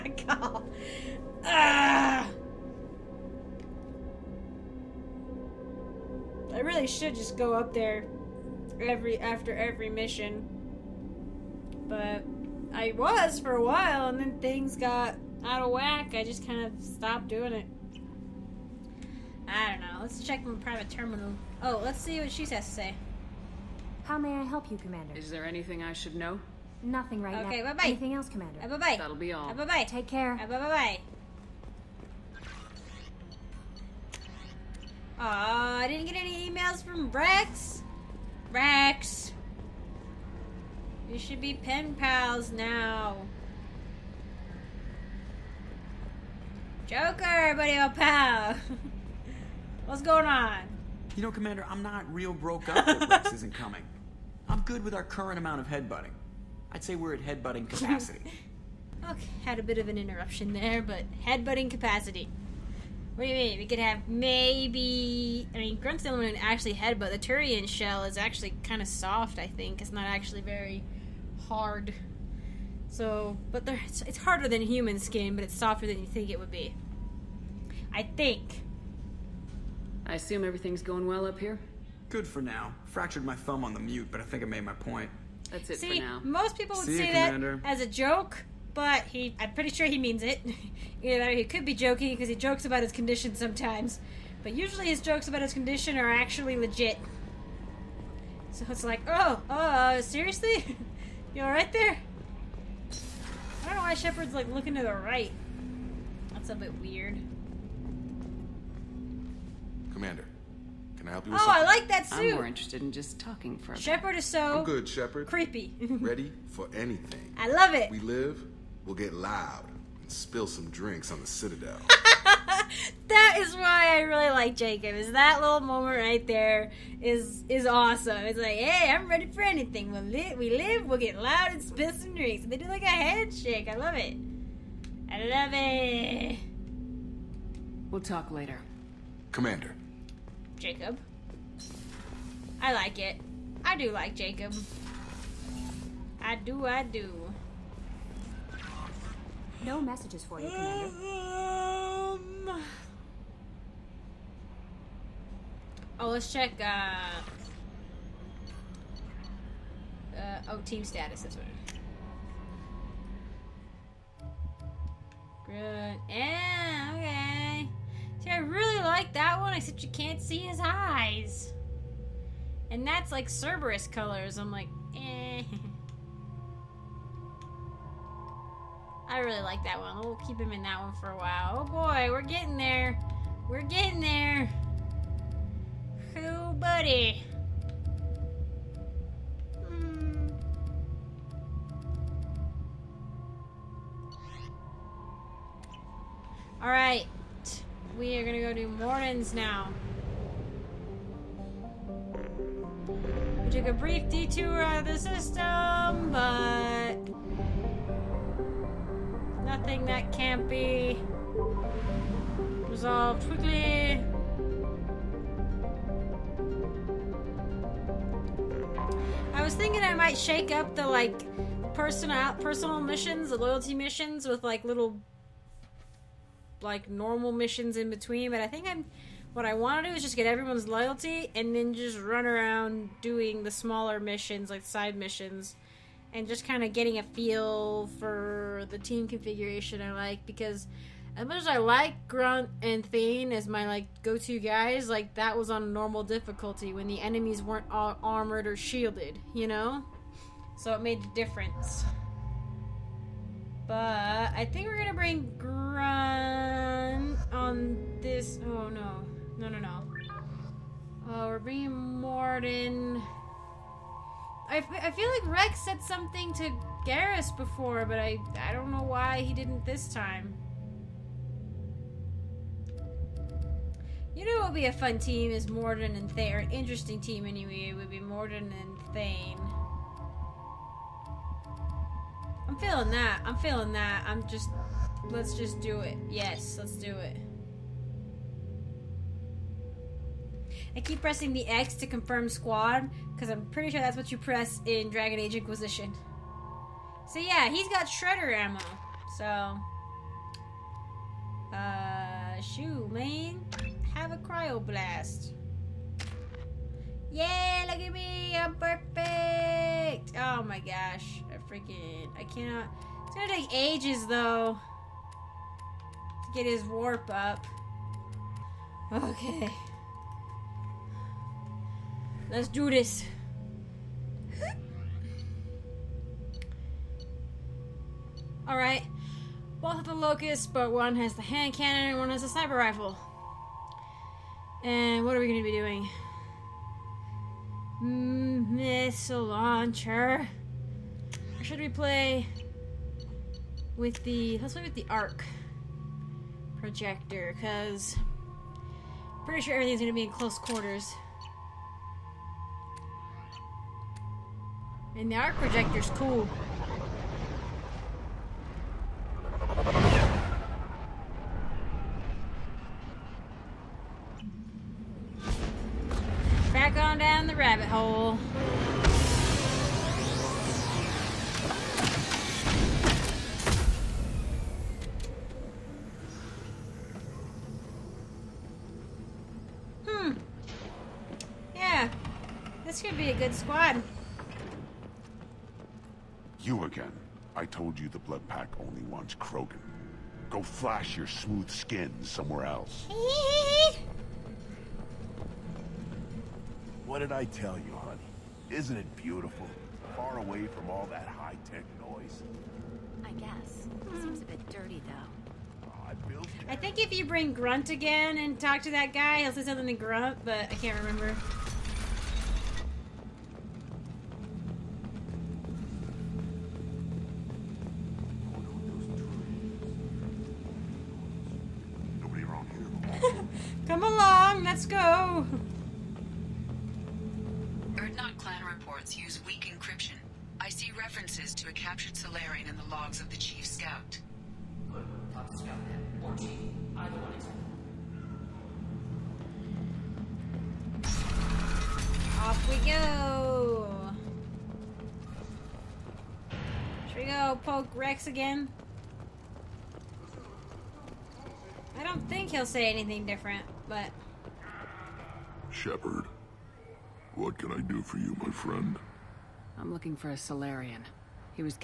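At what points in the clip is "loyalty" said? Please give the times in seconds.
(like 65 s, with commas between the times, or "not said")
223 s, 230 s.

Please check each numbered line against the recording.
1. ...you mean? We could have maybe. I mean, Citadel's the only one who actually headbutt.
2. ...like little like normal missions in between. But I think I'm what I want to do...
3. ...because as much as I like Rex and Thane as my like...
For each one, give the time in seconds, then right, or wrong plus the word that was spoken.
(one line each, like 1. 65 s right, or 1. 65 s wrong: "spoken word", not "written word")
1. 63 s wrong: "Grunt", not "Citadel"
2. 224 s right
3. 240 s wrong: "Grunt", not "Rex".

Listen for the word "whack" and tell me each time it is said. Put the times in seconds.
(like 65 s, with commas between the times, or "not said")
15 s.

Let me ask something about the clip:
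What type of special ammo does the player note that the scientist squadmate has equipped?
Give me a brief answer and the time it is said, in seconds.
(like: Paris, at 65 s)
Shredder ammo, at 297 s.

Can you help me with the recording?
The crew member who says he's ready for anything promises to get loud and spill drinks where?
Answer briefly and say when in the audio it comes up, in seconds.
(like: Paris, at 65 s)
The Citadel, at 121 s.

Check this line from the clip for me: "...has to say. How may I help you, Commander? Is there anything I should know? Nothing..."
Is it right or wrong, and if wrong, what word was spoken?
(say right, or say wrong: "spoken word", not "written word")
right.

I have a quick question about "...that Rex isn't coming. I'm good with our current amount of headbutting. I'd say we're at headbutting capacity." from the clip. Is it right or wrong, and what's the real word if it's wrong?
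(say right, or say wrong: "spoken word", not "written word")
right.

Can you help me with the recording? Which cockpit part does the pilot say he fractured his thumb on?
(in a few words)
The mute.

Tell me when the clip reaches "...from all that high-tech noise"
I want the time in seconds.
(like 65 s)
400 s.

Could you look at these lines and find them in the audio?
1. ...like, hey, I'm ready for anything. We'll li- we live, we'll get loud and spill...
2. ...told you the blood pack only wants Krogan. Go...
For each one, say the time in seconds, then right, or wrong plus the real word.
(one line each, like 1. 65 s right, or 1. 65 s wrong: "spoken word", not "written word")
1. 128 s right
2. 387 s right.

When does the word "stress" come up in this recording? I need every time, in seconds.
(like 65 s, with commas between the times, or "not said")
not said.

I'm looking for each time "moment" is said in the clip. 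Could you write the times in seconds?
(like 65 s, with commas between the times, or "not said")
125 s.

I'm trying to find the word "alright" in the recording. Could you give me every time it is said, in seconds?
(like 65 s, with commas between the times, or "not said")
101 s, 328 s.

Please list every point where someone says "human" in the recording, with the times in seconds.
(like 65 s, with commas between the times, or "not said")
74 s.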